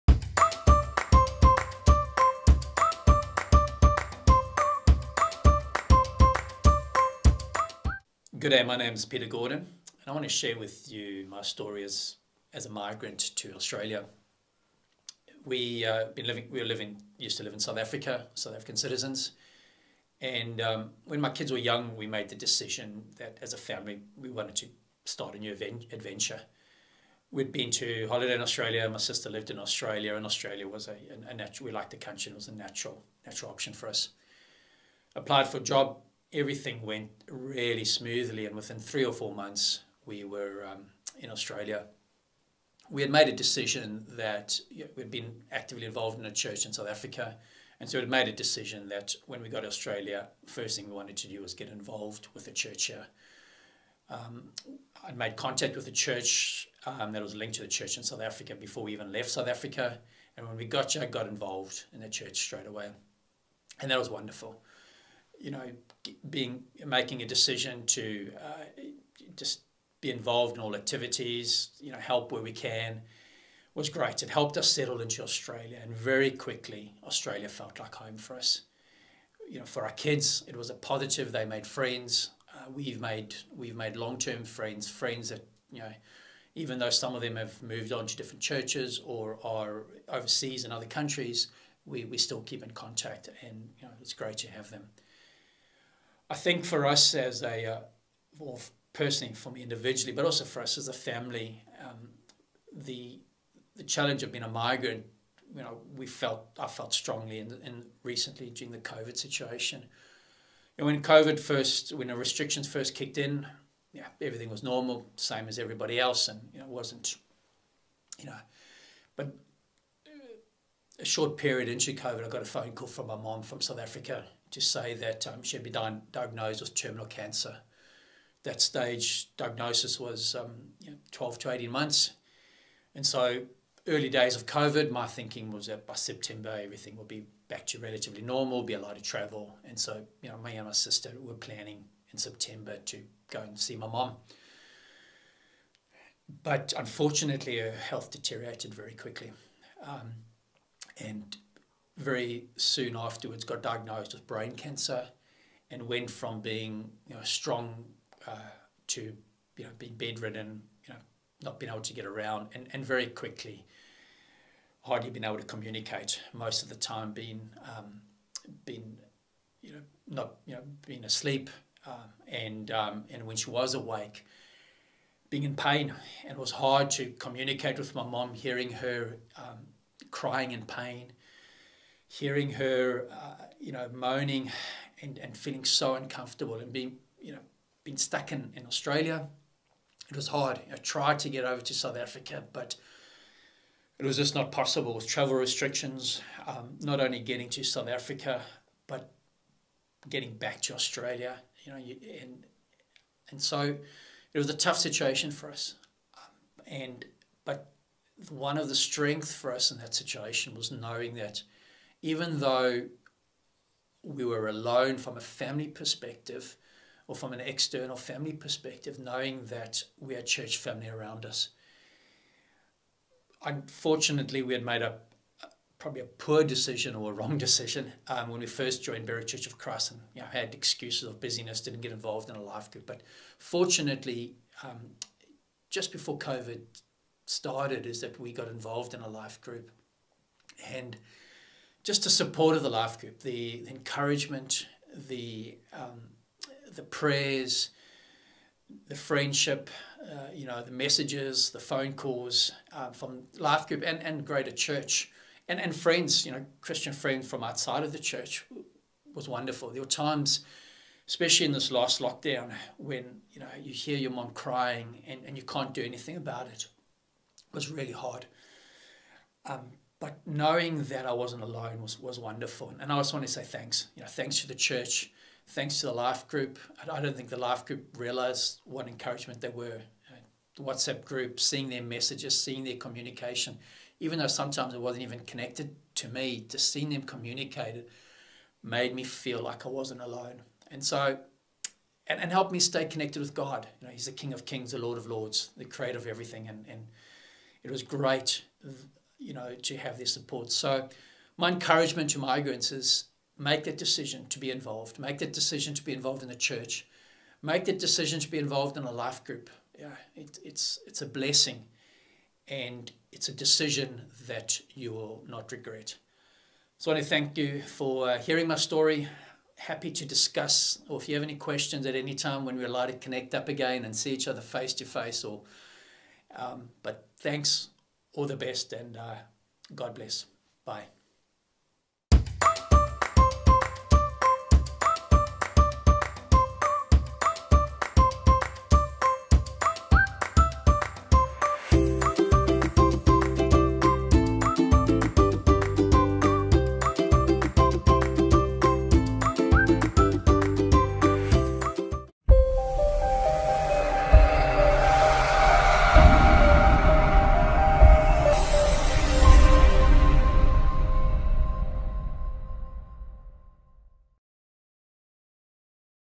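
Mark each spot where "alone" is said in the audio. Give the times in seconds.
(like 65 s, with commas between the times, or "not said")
214 s, 271 s, 290 s.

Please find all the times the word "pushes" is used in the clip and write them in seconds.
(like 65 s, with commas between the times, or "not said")
not said.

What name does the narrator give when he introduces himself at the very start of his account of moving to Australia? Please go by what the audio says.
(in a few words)
Peter Gordon.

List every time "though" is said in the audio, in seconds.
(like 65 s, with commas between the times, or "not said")
86 s, 212 s, 284 s.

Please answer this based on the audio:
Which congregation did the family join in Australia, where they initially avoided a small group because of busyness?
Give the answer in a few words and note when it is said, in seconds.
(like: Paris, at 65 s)
Berwick Church of Christ, at 229 s.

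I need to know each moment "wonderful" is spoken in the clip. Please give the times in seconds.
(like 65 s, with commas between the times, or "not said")
64 s, 259 s, 272 s.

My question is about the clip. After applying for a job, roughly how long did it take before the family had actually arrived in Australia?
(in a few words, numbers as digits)
3 or 4 months.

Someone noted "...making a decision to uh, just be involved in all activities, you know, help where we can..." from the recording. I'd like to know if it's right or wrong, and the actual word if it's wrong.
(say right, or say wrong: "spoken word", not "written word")
right.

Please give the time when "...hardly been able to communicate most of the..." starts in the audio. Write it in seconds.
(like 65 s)
164 s.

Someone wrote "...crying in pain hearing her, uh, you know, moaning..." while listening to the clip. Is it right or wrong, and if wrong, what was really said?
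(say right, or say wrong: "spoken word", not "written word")
right.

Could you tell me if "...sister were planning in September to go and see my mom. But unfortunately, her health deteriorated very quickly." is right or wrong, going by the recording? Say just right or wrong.
right.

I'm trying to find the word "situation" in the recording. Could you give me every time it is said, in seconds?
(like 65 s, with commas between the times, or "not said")
109 s, 204 s, 209 s.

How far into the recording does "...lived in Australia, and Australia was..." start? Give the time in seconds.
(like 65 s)
29 s.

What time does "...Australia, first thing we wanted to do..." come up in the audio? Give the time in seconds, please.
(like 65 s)
49 s.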